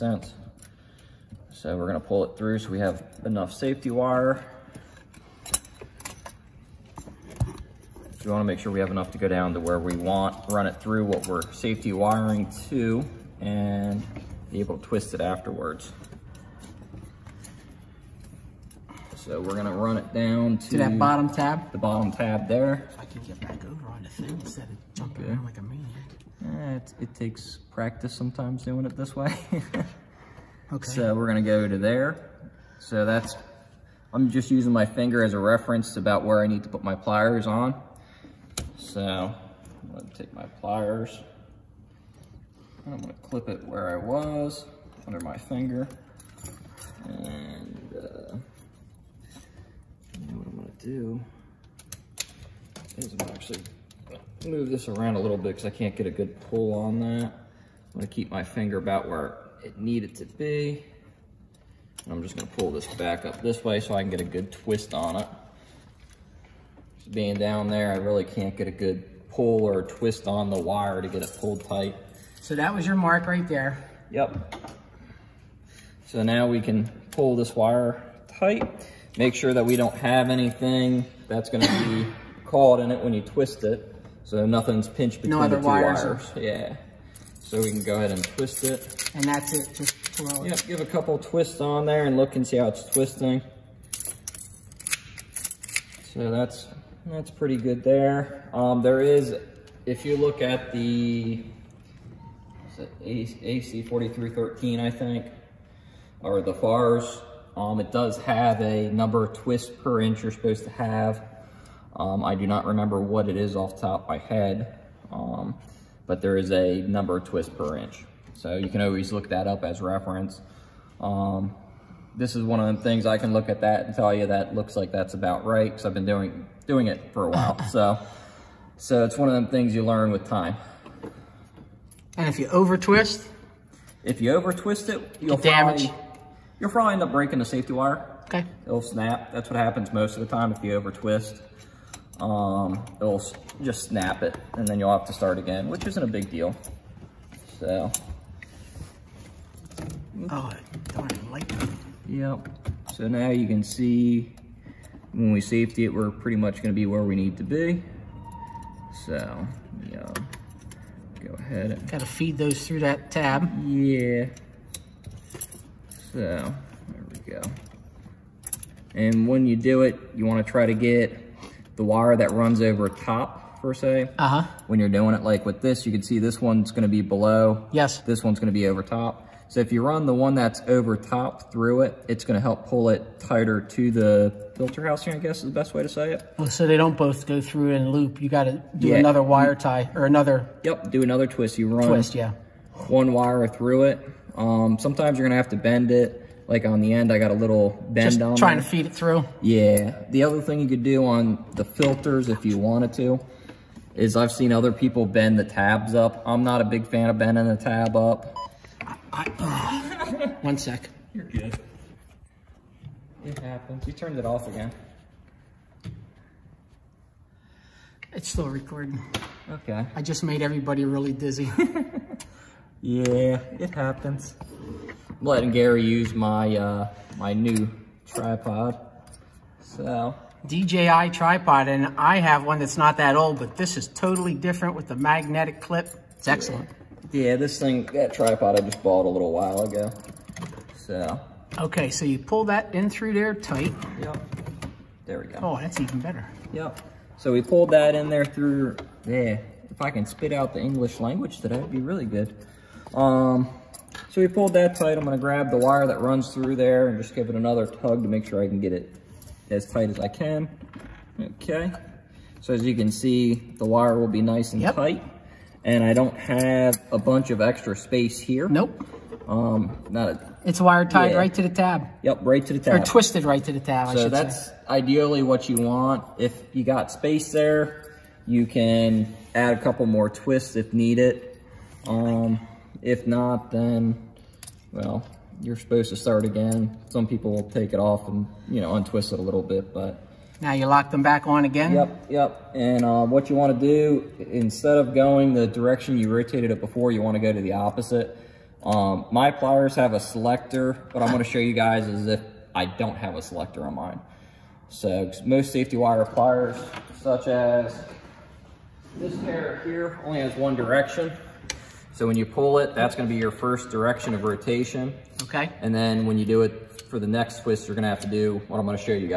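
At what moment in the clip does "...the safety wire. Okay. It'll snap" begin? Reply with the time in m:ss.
2:17.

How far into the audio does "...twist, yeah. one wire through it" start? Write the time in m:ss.
3:11.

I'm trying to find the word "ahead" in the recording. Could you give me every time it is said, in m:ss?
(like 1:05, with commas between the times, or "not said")
1:27, 2:41.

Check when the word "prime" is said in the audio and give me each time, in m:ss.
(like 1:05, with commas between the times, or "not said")
not said.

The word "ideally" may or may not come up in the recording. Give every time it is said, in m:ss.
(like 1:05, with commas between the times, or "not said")
4:34.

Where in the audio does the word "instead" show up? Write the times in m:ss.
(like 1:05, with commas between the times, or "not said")
0:24, 4:54.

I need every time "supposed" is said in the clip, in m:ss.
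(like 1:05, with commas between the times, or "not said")
1:50, 4:45.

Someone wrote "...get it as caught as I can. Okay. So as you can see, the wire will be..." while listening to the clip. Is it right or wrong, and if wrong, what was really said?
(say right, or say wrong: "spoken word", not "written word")
wrong: "tight", not "caught".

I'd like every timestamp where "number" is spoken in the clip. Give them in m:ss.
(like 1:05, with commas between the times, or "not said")
1:48, 1:56.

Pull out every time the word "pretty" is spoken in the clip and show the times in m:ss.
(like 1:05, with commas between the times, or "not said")
1:37, 2:36.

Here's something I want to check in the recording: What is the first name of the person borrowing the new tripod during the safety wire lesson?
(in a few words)
Gary.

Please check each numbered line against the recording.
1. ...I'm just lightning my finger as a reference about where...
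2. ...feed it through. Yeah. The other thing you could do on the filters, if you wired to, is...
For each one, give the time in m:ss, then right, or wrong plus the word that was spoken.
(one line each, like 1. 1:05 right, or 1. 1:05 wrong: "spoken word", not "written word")
1. 0:34 wrong: "using", not "lightning"
2. 3:18 wrong: "wanted", not "wired".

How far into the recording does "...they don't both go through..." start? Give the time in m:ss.
3:06.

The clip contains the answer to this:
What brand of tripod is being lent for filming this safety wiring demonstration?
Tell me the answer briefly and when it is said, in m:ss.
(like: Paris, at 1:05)
DJI, at 3:50.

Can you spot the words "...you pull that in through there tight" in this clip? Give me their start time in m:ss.
4:02.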